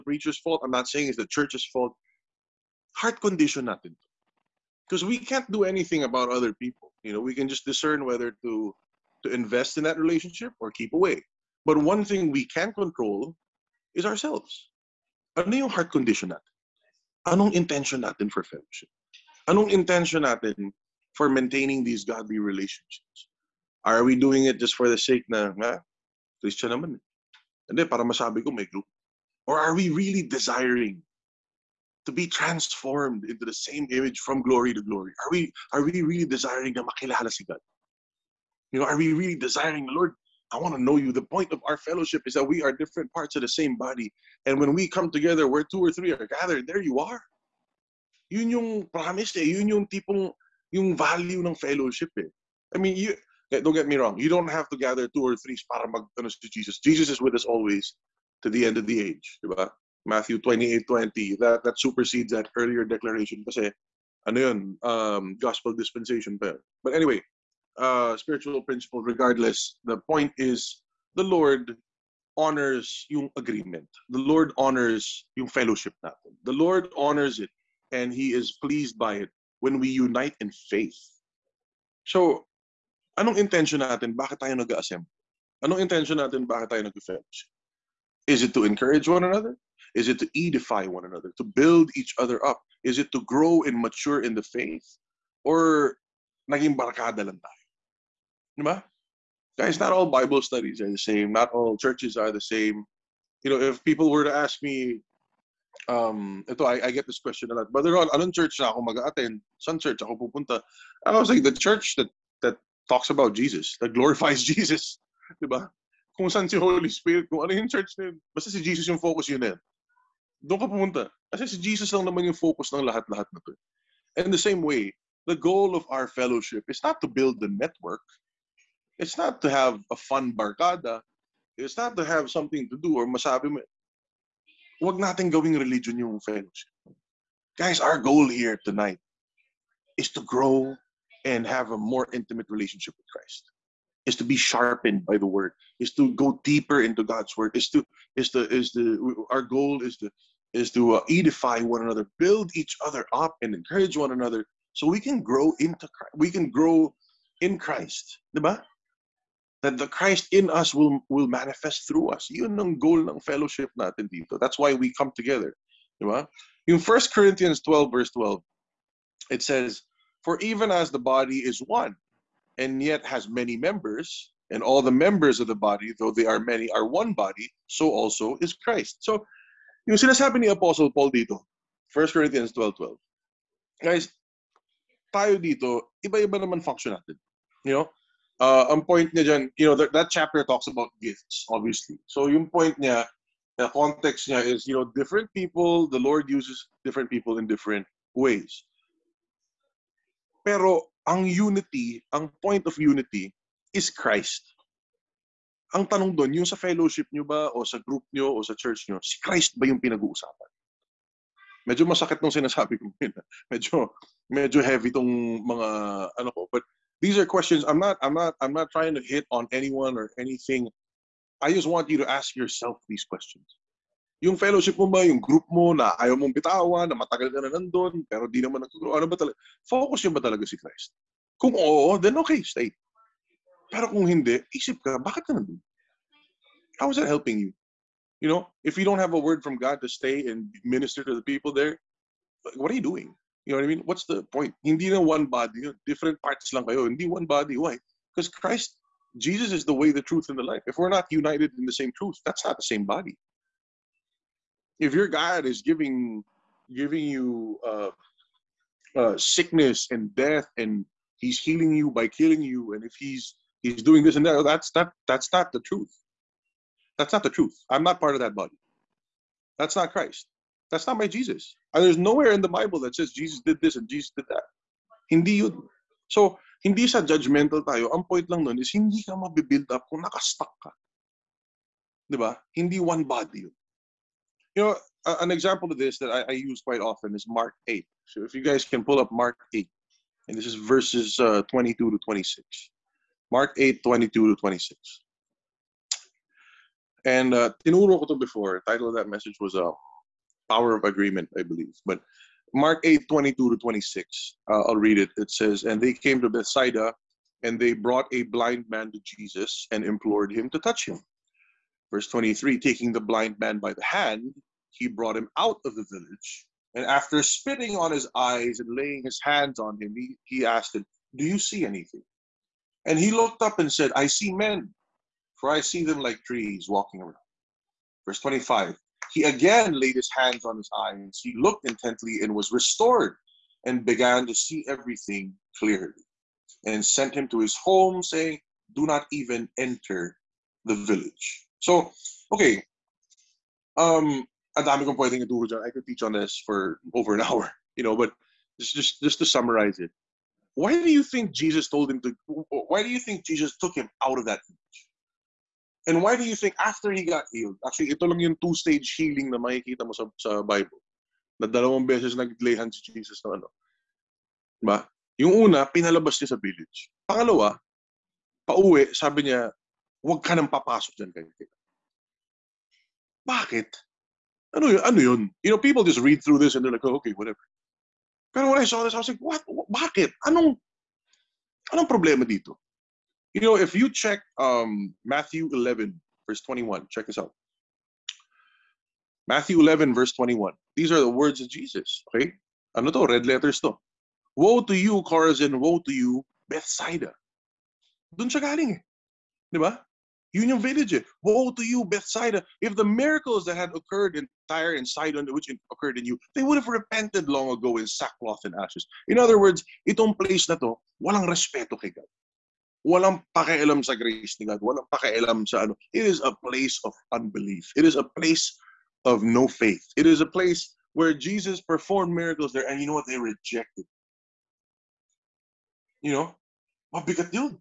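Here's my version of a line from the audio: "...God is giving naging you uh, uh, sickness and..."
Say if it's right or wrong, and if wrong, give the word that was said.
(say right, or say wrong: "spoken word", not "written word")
wrong: "giving", not "naging".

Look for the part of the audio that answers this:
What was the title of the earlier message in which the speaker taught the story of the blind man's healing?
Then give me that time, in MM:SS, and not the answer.
05:00.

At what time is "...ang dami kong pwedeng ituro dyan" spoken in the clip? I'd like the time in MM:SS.
05:44.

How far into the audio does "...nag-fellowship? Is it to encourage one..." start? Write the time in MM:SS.
01:26.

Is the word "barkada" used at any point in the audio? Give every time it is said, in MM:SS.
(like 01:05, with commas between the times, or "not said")
01:36, 02:10.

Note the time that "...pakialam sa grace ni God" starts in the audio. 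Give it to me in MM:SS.
06:53.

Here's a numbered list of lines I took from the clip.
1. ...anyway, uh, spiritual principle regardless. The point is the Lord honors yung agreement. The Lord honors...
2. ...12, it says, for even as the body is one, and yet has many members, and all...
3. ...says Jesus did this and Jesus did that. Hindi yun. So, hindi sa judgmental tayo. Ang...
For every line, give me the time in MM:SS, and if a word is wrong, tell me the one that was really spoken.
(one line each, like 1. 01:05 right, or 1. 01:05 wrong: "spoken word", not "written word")
1. 01:06 right
2. 02:48 right
3. 04:32 right.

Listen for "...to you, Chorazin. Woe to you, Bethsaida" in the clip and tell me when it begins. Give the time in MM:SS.
06:34.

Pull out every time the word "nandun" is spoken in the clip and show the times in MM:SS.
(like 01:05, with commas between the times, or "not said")
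03:47, 03:55.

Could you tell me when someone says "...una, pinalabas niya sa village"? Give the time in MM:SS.
06:05.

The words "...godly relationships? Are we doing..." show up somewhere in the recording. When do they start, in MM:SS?
00:22.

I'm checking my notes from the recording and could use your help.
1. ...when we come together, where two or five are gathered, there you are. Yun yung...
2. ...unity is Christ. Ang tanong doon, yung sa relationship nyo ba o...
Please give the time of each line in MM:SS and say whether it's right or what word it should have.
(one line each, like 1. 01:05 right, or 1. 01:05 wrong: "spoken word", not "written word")
1. 00:44 wrong: "three", not "five"
2. 03:22 wrong: "fellowship", not "relationship".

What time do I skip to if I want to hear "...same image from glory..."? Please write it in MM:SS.
00:33.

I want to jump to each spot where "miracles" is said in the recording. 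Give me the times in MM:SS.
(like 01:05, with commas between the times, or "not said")
06:42, 07:02.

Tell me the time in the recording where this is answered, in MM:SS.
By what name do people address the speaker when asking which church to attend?
01:47.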